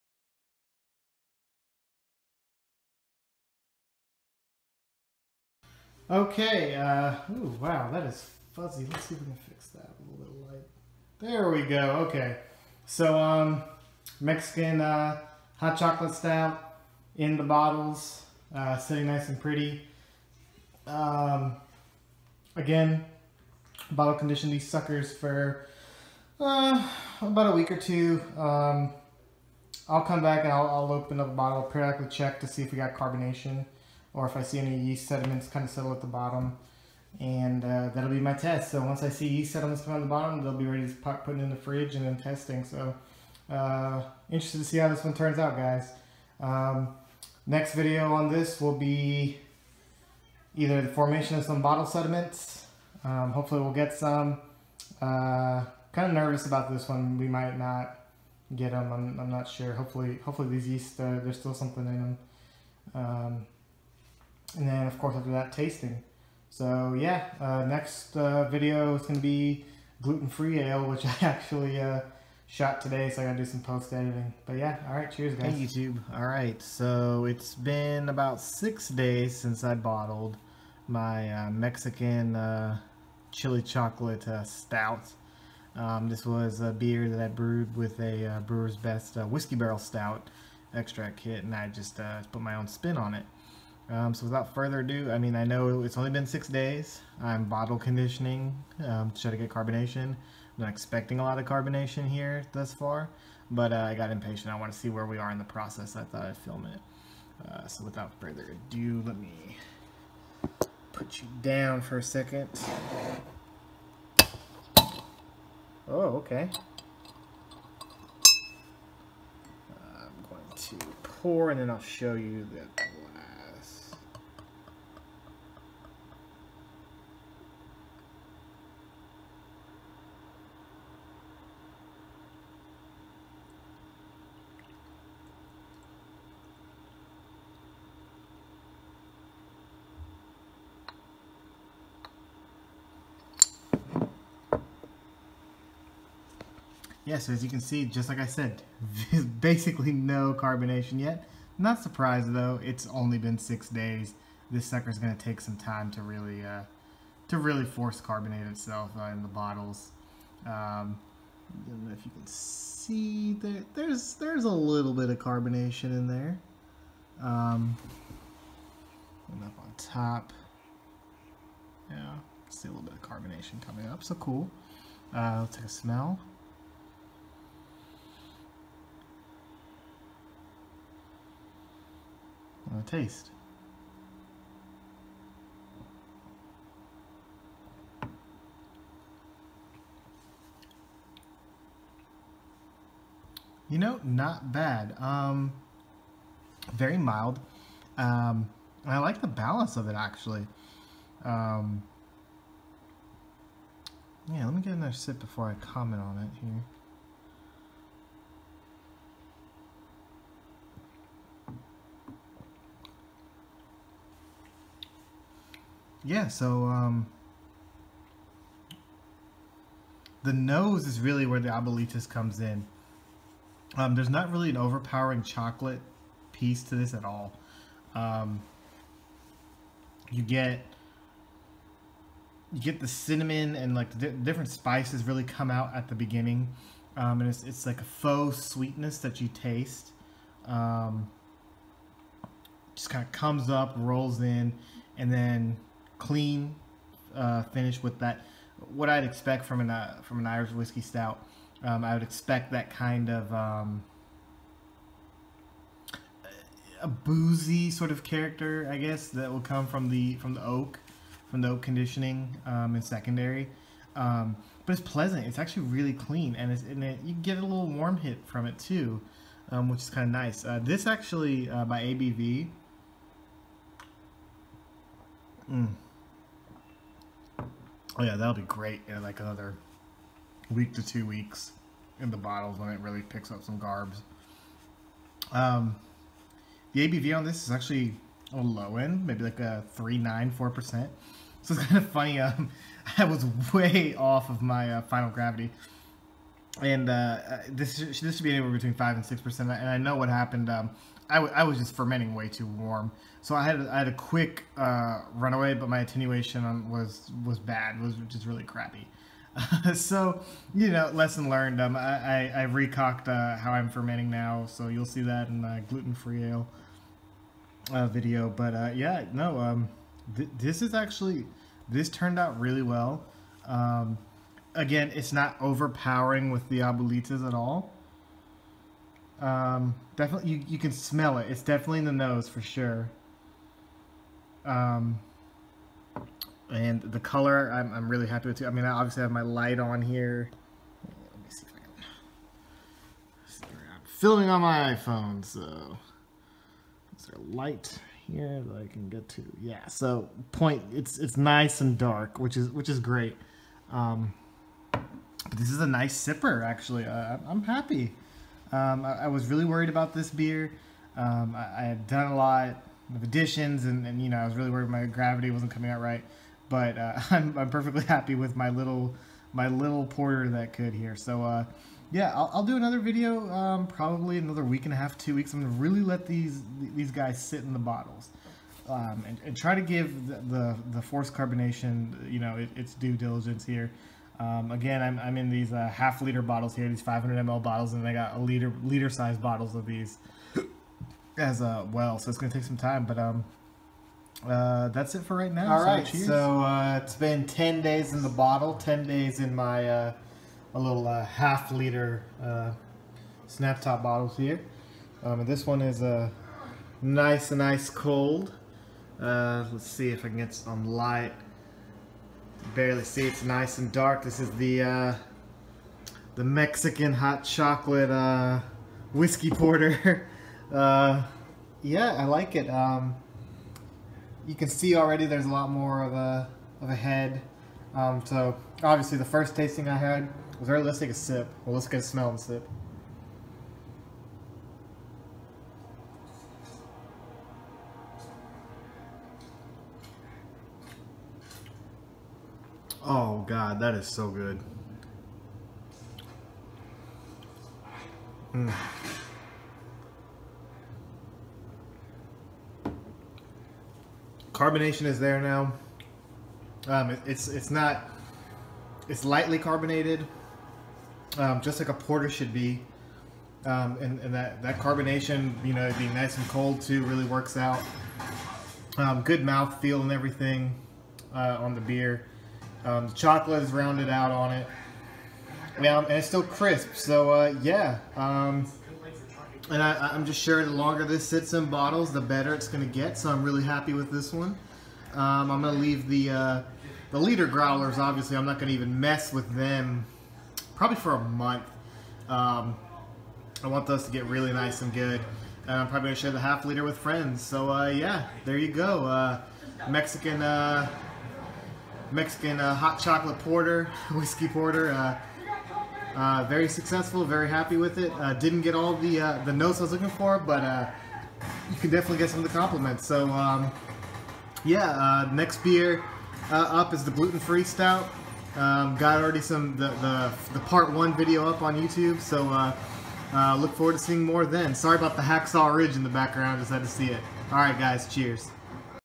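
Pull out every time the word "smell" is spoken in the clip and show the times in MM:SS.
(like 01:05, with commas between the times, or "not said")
02:55, 05:30, 07:11.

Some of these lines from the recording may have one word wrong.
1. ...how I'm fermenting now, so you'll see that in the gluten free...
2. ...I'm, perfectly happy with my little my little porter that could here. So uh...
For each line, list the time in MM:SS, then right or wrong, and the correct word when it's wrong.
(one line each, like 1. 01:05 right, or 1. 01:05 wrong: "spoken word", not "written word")
1. 05:13 right
2. 06:07 right.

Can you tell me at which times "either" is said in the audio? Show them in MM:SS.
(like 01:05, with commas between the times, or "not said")
00:50.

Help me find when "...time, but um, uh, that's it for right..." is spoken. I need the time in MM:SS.
06:32.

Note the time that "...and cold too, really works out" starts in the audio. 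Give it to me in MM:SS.
07:46.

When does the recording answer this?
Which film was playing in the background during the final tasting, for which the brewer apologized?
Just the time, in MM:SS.
08:45.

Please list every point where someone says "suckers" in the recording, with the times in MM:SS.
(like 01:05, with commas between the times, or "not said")
00:24, 02:34.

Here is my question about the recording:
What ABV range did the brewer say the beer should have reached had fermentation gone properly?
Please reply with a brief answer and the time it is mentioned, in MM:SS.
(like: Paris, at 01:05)
5 to 6 percent, at 04:58.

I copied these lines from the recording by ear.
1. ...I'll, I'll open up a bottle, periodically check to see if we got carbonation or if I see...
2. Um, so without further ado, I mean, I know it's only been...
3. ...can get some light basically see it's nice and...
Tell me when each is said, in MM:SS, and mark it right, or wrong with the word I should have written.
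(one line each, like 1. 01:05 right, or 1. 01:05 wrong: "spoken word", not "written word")
1. 00:30 right
2. 01:33 right
3. 06:50 wrong: "barely", not "basically".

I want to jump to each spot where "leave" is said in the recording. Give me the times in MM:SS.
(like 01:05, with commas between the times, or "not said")
08:05.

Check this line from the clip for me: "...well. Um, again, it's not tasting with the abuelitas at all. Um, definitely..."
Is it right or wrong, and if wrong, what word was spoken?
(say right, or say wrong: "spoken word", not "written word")
wrong: "overpowering", not "tasting".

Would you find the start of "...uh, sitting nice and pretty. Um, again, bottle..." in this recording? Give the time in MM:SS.
00:18.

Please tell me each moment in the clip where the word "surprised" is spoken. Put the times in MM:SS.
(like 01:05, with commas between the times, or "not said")
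02:31.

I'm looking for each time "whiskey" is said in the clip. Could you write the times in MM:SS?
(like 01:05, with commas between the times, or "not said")
01:29, 04:10, 06:58, 08:23.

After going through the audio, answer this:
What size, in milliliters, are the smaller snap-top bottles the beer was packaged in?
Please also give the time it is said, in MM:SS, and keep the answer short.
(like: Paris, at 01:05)
500 ml, at 06:26.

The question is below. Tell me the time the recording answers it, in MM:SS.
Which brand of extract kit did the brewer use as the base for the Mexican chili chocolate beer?
01:28.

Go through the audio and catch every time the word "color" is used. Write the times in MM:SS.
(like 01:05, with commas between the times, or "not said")
05:36.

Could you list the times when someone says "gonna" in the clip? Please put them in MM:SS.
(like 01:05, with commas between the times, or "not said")
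02:34, 06:15, 06:32.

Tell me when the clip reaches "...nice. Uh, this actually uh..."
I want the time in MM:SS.
04:30.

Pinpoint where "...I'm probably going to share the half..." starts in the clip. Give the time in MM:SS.
08:15.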